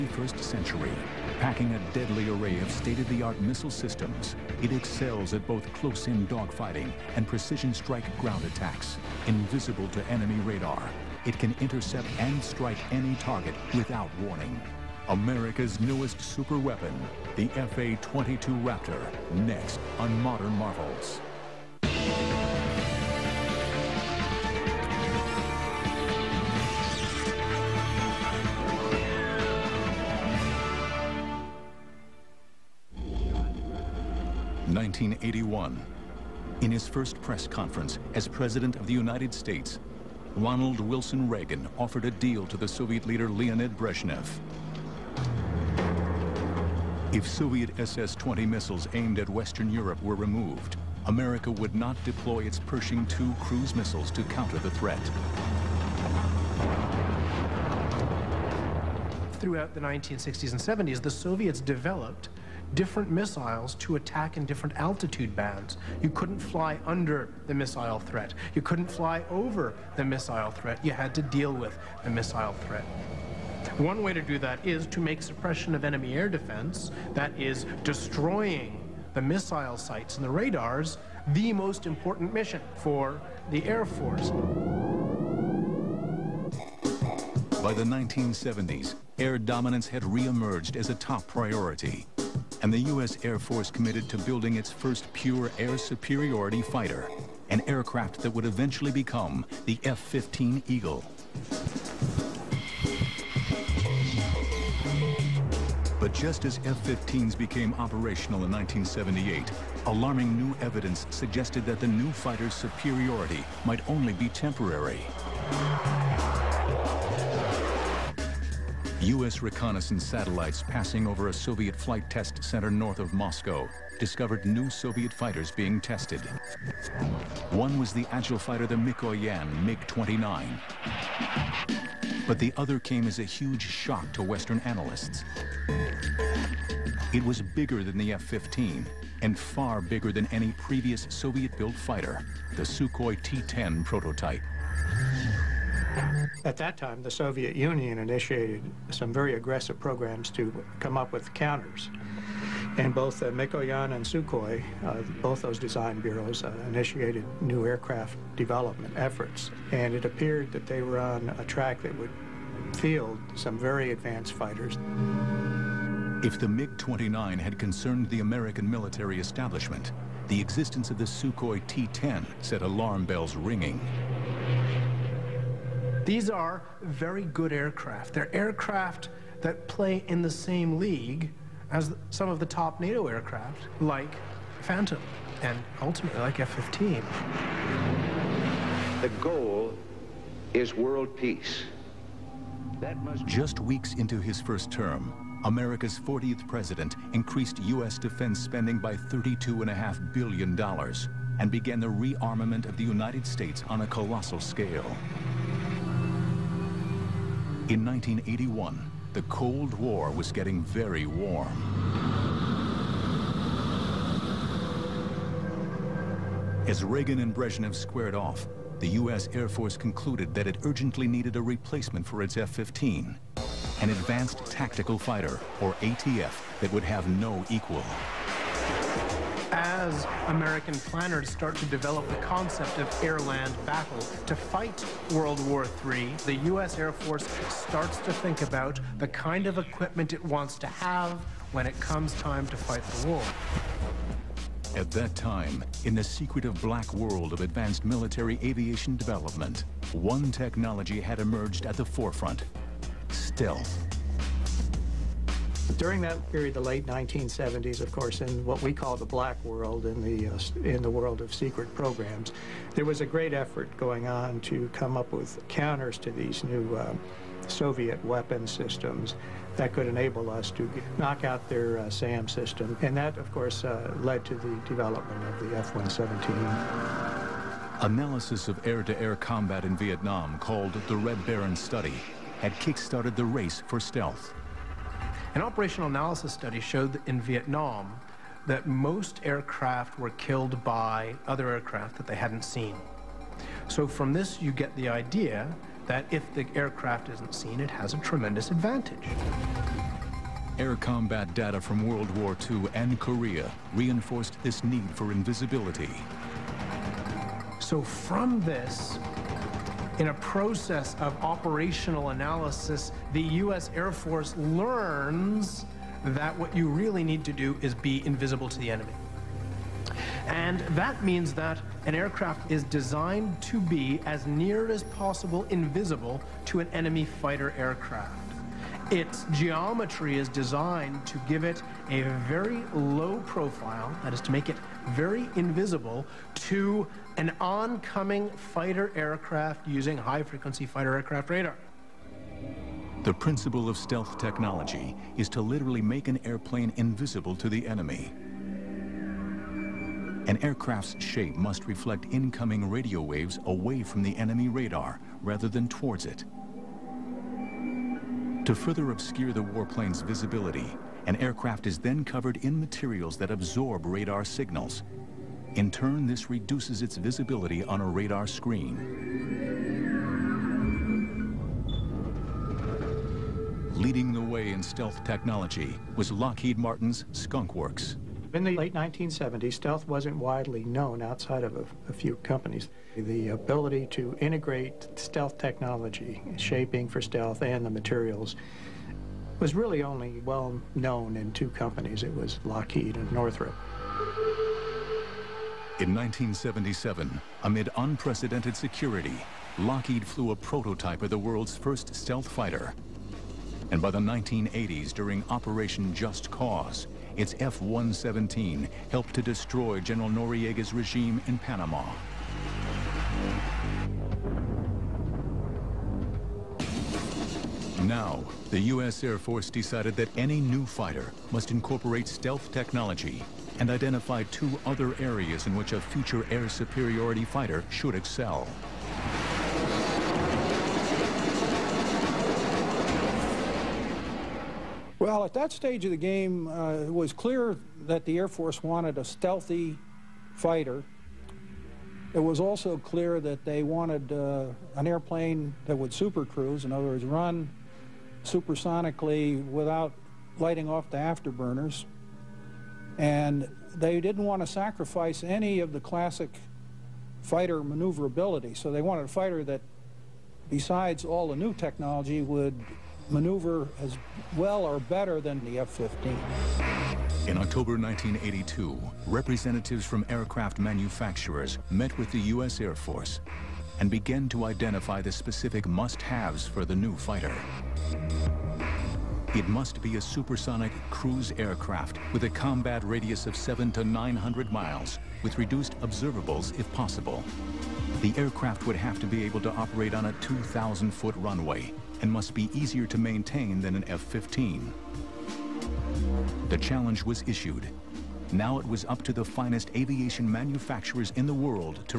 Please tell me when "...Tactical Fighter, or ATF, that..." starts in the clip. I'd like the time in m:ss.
3:44.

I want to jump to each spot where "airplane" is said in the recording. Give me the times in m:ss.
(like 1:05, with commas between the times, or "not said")
5:46, 7:24.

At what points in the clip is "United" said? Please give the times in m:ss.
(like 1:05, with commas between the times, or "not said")
0:38, 3:22.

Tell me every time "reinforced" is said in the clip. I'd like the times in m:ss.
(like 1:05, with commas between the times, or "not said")
5:03.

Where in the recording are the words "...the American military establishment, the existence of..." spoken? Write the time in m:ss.
2:48.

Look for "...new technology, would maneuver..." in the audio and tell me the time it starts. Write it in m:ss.
7:41.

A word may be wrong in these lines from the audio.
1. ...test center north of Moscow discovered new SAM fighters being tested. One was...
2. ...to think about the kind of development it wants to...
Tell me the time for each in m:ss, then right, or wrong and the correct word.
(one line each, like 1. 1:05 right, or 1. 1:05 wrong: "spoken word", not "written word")
1. 2:02 wrong: "Soviet", not "SAM"
2. 3:57 wrong: "equipment", not "development".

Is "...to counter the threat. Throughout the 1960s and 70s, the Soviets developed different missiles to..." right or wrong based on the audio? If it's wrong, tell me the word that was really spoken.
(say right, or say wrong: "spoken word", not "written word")
right.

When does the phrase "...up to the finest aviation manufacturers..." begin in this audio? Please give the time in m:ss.
8:18.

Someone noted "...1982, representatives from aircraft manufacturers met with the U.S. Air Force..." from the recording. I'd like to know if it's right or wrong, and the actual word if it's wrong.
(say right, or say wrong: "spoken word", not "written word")
right.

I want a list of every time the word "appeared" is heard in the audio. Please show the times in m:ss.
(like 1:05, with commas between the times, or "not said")
2:40.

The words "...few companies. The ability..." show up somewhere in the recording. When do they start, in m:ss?
6:21.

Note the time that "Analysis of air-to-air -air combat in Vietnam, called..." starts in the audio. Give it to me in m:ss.
4:37.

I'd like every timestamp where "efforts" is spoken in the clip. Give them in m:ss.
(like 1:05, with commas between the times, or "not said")
2:38, 4:23.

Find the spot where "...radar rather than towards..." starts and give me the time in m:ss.
5:54.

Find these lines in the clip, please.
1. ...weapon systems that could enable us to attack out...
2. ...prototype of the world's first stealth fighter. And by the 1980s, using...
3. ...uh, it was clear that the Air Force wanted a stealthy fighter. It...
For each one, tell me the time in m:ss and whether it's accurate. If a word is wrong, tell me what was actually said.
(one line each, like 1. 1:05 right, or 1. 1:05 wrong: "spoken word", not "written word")
1. 4:28 wrong: "knock", not "attack"
2. 6:40 wrong: "during", not "using"
3. 7:16 right.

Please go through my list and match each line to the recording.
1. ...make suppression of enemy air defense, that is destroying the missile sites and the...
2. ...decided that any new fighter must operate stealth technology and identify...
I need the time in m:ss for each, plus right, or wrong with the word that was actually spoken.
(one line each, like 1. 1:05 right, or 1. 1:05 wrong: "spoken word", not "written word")
1. 1:15 right
2. 6:59 wrong: "incorporate", not "operate".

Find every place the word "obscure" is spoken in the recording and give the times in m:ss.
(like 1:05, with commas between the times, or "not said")
5:58.